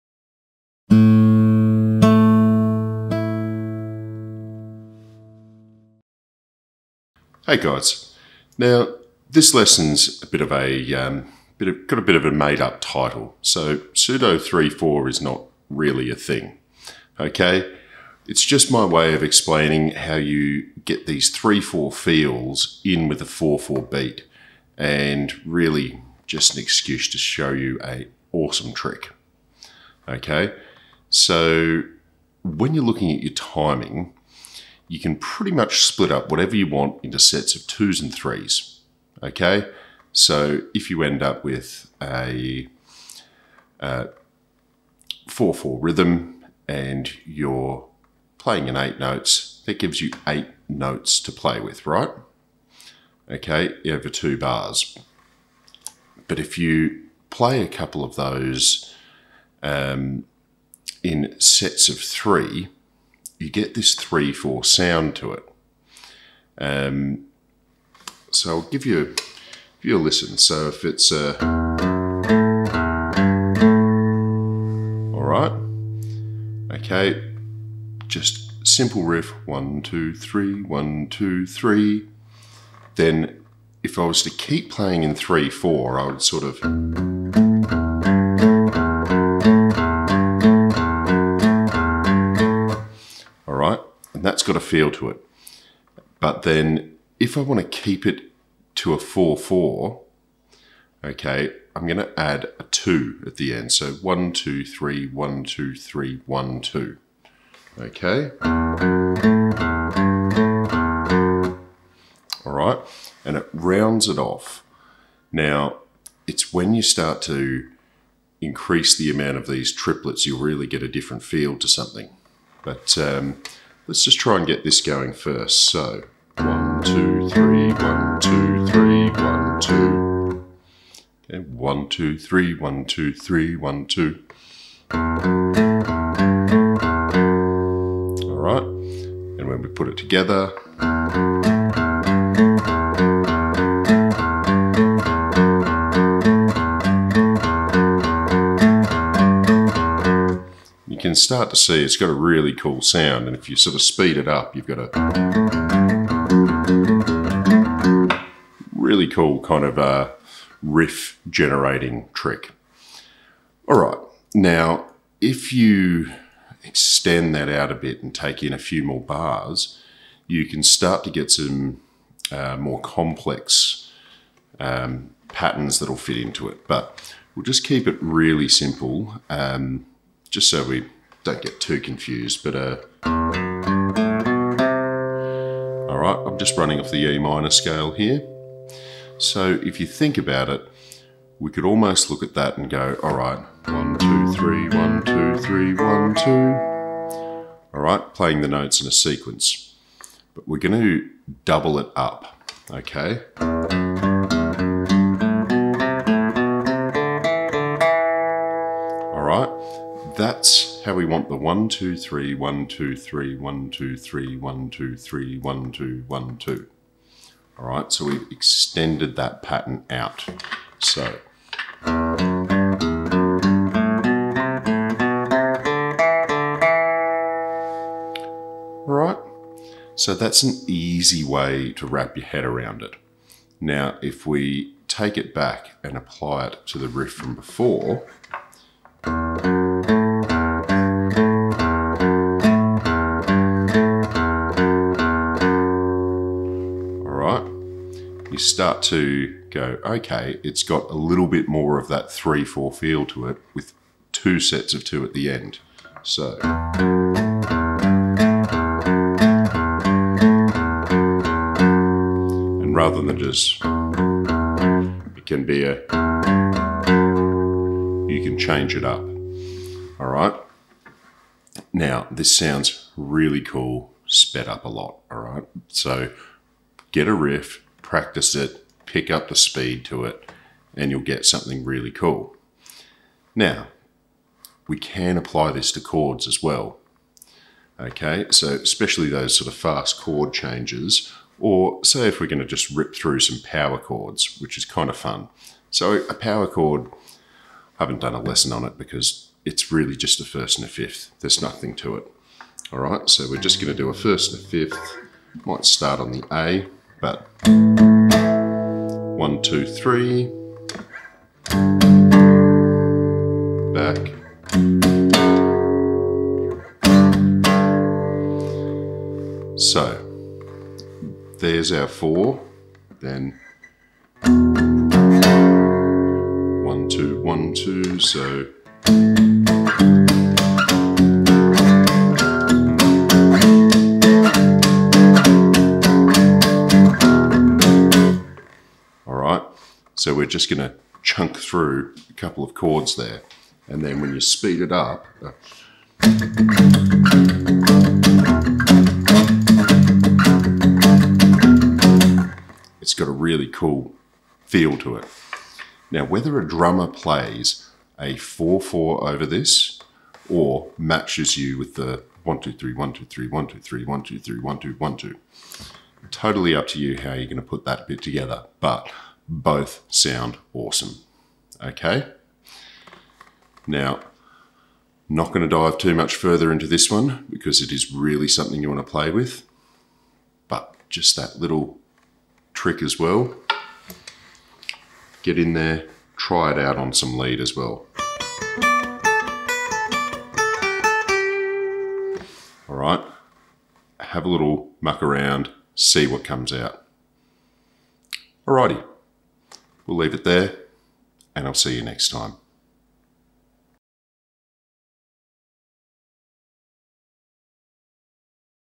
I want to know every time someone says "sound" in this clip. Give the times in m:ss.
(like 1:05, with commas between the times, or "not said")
1:04, 2:32, 4:32, 6:09.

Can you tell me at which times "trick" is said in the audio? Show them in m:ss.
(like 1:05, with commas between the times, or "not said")
0:28, 2:42, 6:22.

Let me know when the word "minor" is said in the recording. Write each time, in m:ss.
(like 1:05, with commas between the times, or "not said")
3:07.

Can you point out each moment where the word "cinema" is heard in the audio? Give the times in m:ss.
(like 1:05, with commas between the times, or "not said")
not said.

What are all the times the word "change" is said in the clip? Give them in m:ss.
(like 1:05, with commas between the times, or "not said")
4:28, 4:50.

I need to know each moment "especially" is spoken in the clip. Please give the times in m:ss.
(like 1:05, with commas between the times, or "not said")
4:48.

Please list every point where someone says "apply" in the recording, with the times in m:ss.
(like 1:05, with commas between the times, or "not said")
3:55, 4:45.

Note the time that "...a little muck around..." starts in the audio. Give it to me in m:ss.
6:34.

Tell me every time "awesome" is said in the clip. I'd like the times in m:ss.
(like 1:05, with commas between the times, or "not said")
0:28, 6:10.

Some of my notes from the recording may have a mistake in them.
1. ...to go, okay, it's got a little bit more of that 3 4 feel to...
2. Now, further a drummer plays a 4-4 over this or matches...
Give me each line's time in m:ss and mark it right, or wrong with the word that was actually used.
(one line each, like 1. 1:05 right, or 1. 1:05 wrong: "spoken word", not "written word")
1. 4:08 right
2. 5:55 wrong: "whether", not "further".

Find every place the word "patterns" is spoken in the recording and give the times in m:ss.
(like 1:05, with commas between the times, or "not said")
2:55, 3:39.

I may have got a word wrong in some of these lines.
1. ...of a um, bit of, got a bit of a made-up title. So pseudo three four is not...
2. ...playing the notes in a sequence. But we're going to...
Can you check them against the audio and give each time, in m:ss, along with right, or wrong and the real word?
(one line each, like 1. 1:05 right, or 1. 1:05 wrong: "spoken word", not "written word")
1. 0:10 right
2. 3:18 right.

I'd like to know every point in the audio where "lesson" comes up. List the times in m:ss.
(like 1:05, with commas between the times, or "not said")
0:09, 4:58.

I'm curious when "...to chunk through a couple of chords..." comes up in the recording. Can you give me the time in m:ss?
5:40.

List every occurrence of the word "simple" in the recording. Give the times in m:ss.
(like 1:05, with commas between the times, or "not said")
1:18, 2:58.